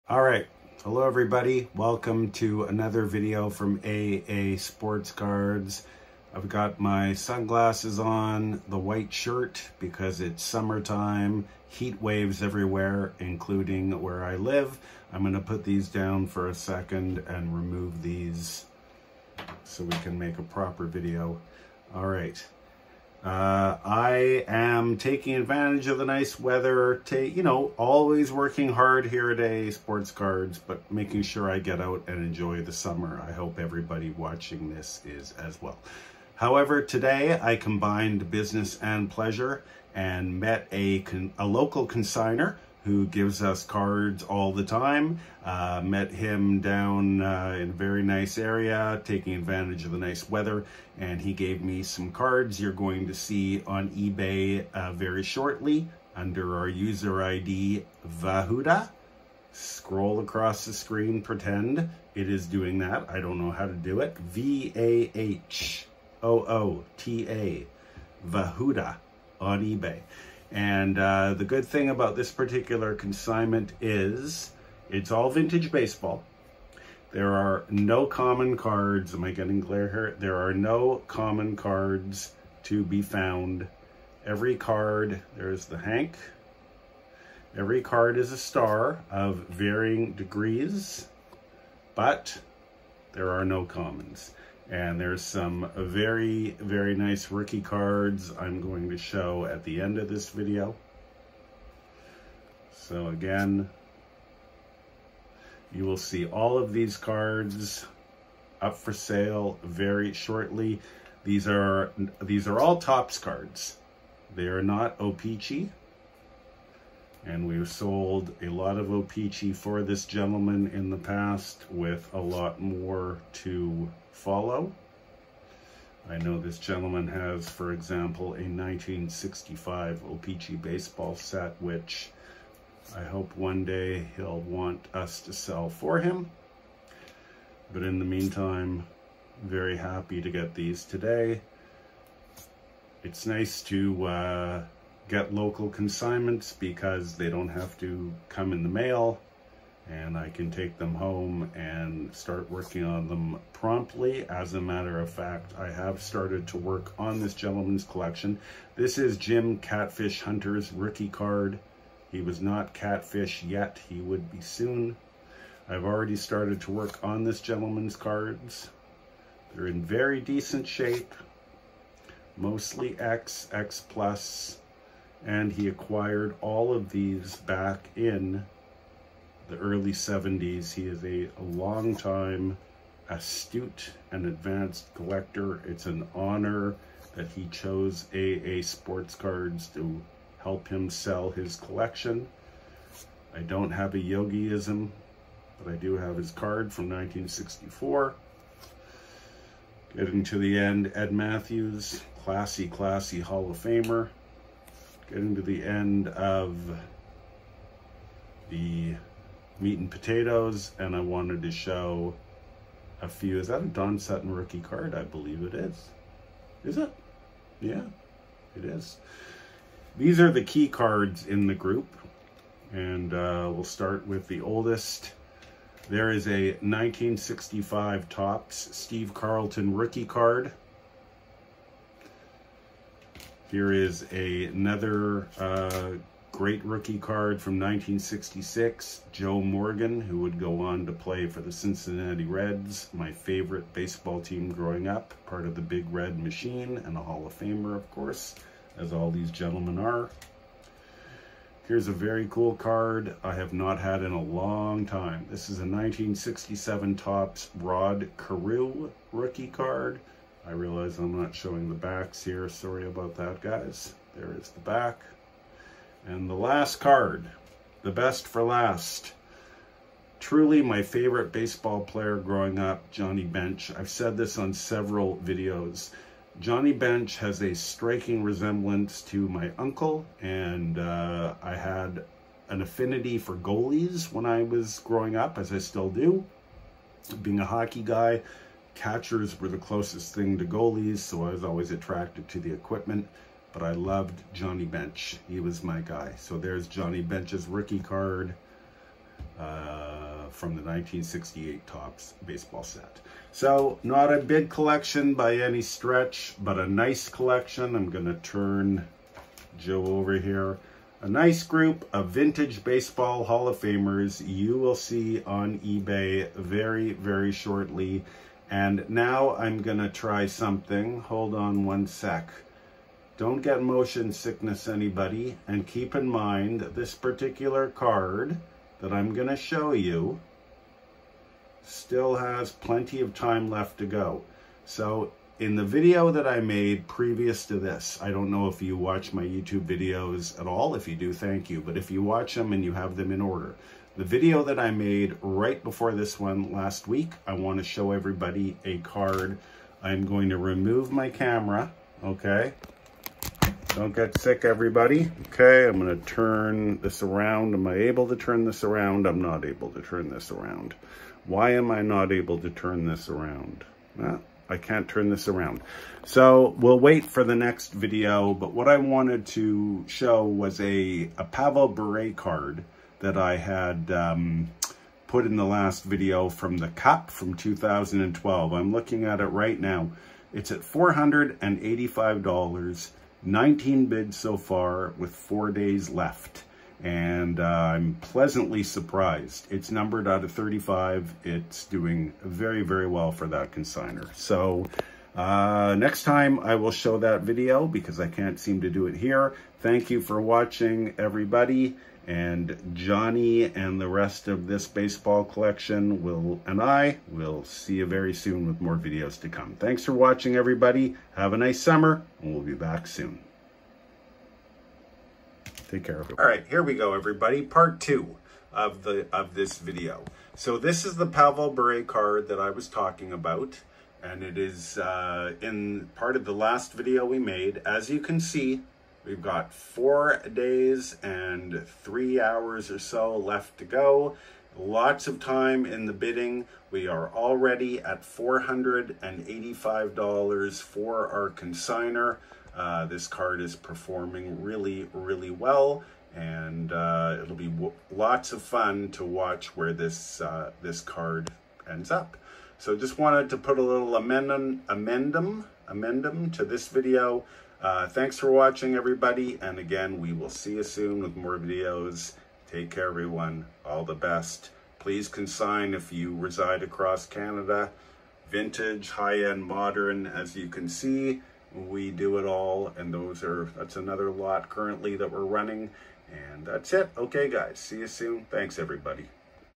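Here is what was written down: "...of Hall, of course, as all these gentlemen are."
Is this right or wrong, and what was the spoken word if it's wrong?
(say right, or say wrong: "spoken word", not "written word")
wrong: "Famer", not "Hall".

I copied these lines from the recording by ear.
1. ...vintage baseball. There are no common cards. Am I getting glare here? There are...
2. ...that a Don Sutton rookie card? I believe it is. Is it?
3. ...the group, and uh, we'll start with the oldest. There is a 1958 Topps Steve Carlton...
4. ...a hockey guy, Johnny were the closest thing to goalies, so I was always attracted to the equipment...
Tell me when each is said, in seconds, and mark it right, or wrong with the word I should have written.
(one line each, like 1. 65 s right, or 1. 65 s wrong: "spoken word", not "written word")
1. 75 s right
2. 213 s right
3. 221 s wrong: "1965", not "1958"
4. 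287 s wrong: "Catchers", not "Johnny".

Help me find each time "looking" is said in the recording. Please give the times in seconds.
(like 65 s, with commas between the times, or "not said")
378 s.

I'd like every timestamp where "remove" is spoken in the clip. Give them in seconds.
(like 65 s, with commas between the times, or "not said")
17 s, 350 s.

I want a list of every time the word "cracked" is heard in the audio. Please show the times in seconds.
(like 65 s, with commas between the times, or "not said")
not said.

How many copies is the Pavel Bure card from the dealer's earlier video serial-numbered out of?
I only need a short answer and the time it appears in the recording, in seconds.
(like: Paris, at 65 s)
35, at 389 s.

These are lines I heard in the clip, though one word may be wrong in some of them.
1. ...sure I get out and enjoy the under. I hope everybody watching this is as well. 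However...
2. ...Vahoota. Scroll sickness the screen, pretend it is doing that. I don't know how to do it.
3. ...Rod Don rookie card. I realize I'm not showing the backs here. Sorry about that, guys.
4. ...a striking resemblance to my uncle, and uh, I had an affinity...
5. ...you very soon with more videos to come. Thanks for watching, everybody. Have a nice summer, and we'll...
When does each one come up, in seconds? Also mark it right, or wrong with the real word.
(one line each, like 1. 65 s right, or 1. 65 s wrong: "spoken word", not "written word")
1. 31 s wrong: "summer", not "under"
2. 58 s wrong: "across", not "sickness"
3. 257 s wrong: "Carew", not "Don"
4. 277 s right
5. 407 s right.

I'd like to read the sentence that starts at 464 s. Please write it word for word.
Please consign if you reside across Canada.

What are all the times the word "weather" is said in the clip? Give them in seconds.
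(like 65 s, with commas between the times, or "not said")
26 s, 50 s.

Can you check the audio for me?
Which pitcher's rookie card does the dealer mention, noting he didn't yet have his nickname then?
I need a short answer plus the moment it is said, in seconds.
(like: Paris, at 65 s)
Jim Catfish Hunter, at 159 s.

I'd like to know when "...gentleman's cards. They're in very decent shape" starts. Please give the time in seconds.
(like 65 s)
167 s.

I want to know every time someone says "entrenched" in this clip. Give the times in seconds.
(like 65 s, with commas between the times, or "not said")
not said.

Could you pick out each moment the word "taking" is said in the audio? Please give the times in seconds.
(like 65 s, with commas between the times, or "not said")
24 s, 49 s.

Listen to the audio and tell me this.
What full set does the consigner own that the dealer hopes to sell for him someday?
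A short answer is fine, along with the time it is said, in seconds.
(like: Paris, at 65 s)
1965 O-Pee-Chee baseball set, at 128 s.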